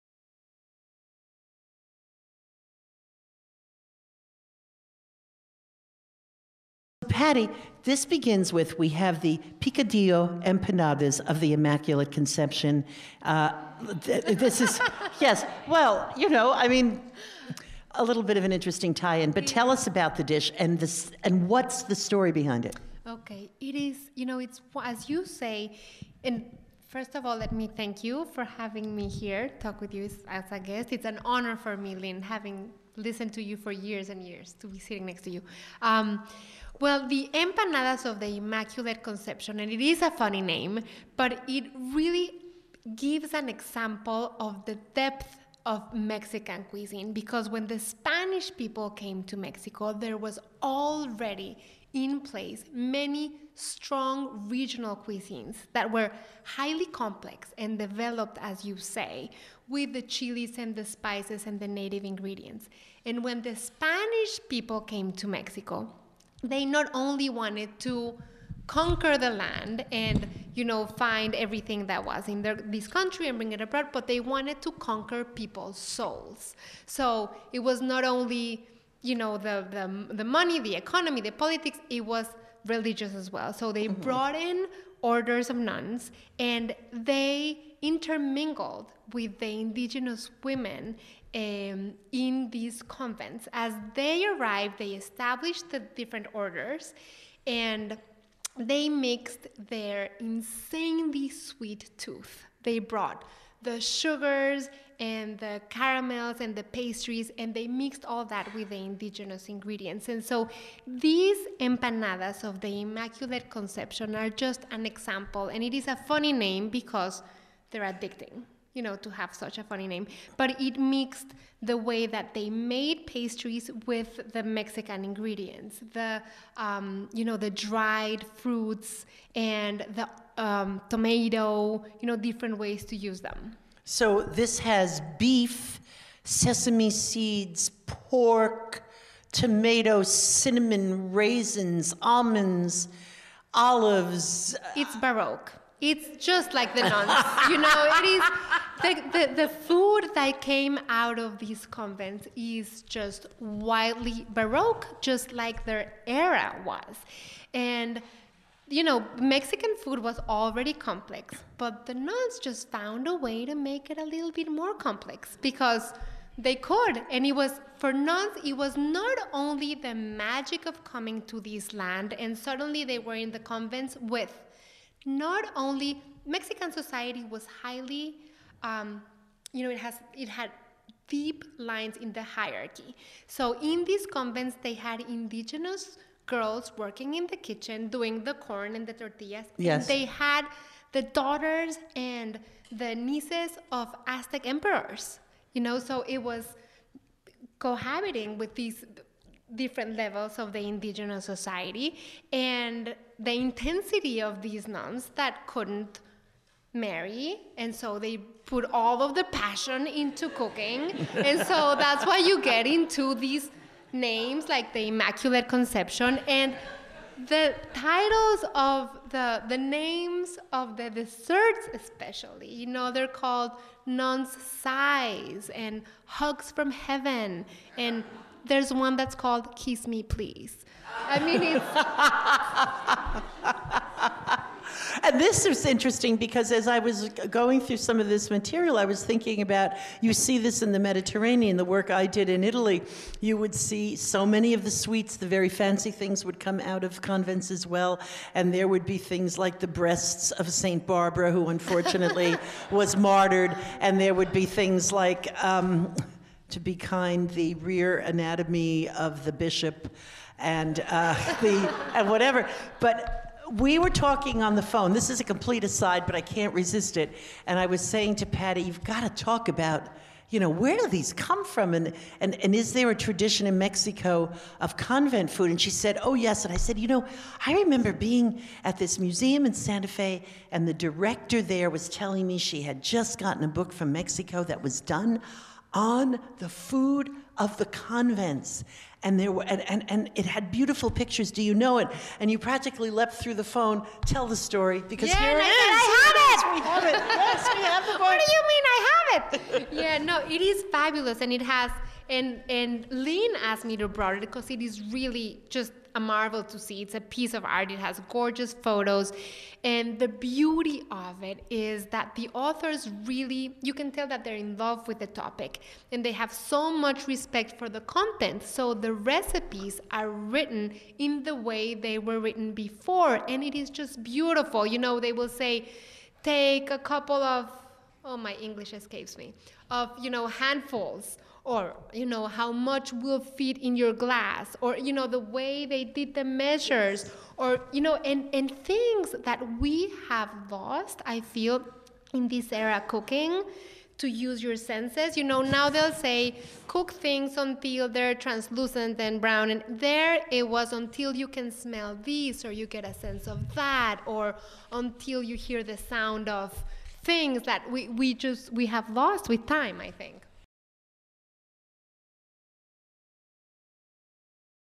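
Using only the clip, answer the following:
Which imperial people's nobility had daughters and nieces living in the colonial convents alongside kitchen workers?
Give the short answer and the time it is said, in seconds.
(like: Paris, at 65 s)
Aztec, at 194 s.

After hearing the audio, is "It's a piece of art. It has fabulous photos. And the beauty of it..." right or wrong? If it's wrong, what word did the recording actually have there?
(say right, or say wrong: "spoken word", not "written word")
wrong: "gorgeous", not "fabulous".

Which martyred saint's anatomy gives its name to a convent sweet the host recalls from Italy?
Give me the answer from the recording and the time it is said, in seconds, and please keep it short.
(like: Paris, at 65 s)
St. Barbara, at 250 s.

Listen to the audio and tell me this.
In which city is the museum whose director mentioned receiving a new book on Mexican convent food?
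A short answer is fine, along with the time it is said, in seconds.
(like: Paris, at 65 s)
Santa Fe, at 279 s.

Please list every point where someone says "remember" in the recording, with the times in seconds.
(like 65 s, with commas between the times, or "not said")
277 s.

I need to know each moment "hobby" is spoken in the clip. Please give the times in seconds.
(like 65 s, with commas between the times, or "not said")
not said.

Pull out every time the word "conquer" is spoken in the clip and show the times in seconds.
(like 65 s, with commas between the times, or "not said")
68 s, 74 s.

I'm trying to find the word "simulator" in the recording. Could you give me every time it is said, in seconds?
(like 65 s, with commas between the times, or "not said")
not said.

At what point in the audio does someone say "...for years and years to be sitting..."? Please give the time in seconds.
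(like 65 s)
33 s.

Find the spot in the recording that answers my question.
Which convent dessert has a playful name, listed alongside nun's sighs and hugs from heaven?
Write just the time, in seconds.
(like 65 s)
229 s.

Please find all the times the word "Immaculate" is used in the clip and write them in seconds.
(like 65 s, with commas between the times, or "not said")
11 s, 38 s, 112 s, 214 s.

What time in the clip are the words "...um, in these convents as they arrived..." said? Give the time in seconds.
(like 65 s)
91 s.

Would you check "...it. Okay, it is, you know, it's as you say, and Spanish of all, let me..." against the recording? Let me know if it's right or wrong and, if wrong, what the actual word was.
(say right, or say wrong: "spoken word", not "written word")
wrong: "First", not "Spanish".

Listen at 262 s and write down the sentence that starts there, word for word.
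But we were talking on the phone.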